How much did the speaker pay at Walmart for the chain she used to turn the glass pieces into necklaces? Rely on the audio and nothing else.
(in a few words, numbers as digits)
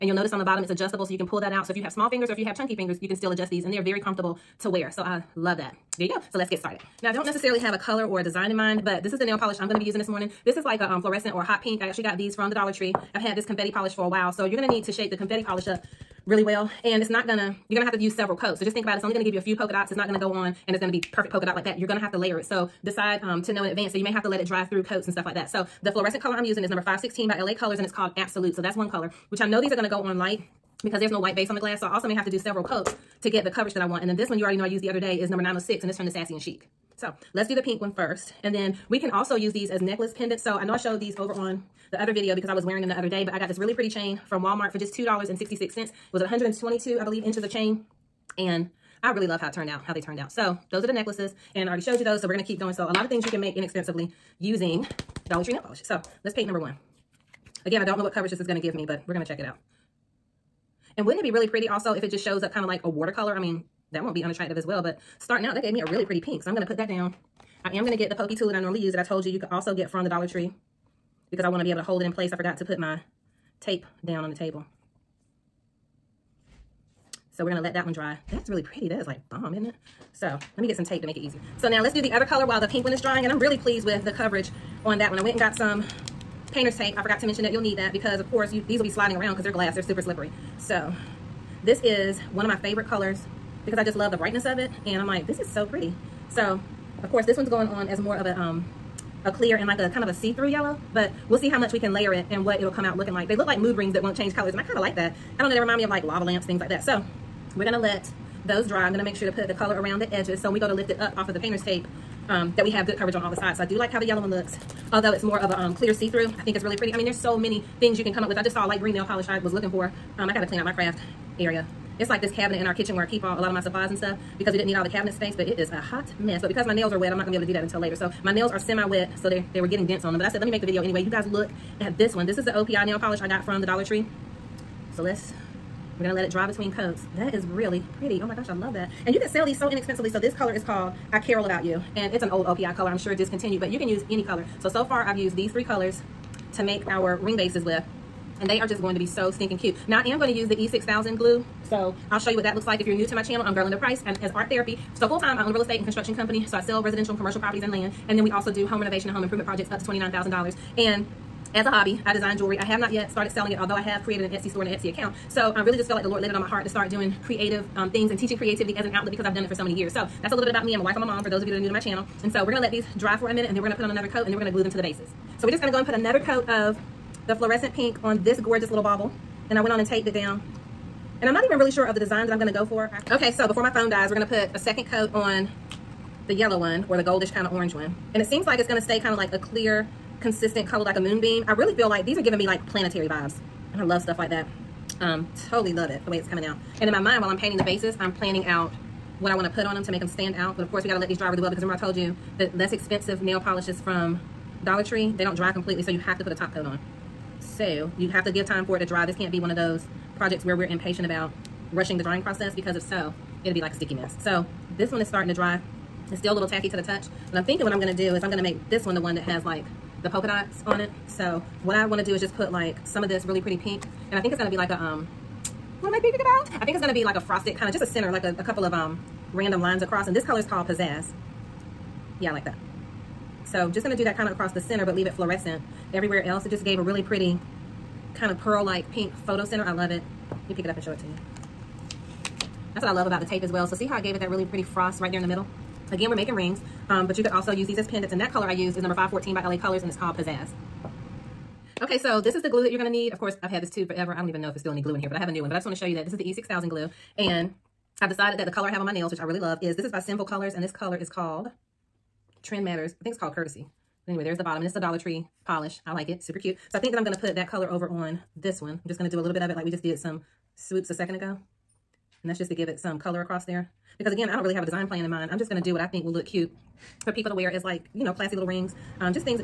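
$2.66.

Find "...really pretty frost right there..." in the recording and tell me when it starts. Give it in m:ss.
4:04.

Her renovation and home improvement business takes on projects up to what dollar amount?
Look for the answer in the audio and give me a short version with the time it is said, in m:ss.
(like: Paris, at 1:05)
$29,000, at 2:39.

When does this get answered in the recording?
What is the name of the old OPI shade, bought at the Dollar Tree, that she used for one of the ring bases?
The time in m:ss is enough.
2:21.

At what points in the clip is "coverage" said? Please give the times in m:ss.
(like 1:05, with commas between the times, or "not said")
0:33, 0:58, 1:24, 1:52.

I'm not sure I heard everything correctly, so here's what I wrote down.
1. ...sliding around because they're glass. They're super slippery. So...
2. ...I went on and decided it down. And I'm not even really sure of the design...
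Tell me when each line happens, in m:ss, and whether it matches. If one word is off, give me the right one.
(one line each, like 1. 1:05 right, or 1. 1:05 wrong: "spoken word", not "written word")
1. 1:28 right
2. 2:59 wrong: "taped", not "decided".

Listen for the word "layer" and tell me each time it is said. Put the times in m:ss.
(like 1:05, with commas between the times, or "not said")
0:22, 1:41.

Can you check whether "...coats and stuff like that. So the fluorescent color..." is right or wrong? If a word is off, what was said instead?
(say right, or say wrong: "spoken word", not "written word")
right.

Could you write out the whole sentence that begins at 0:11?
I actually got these from the Dollar Tree.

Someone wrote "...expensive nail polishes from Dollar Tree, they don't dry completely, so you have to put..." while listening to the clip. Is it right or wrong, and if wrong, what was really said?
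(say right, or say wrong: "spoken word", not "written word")
right.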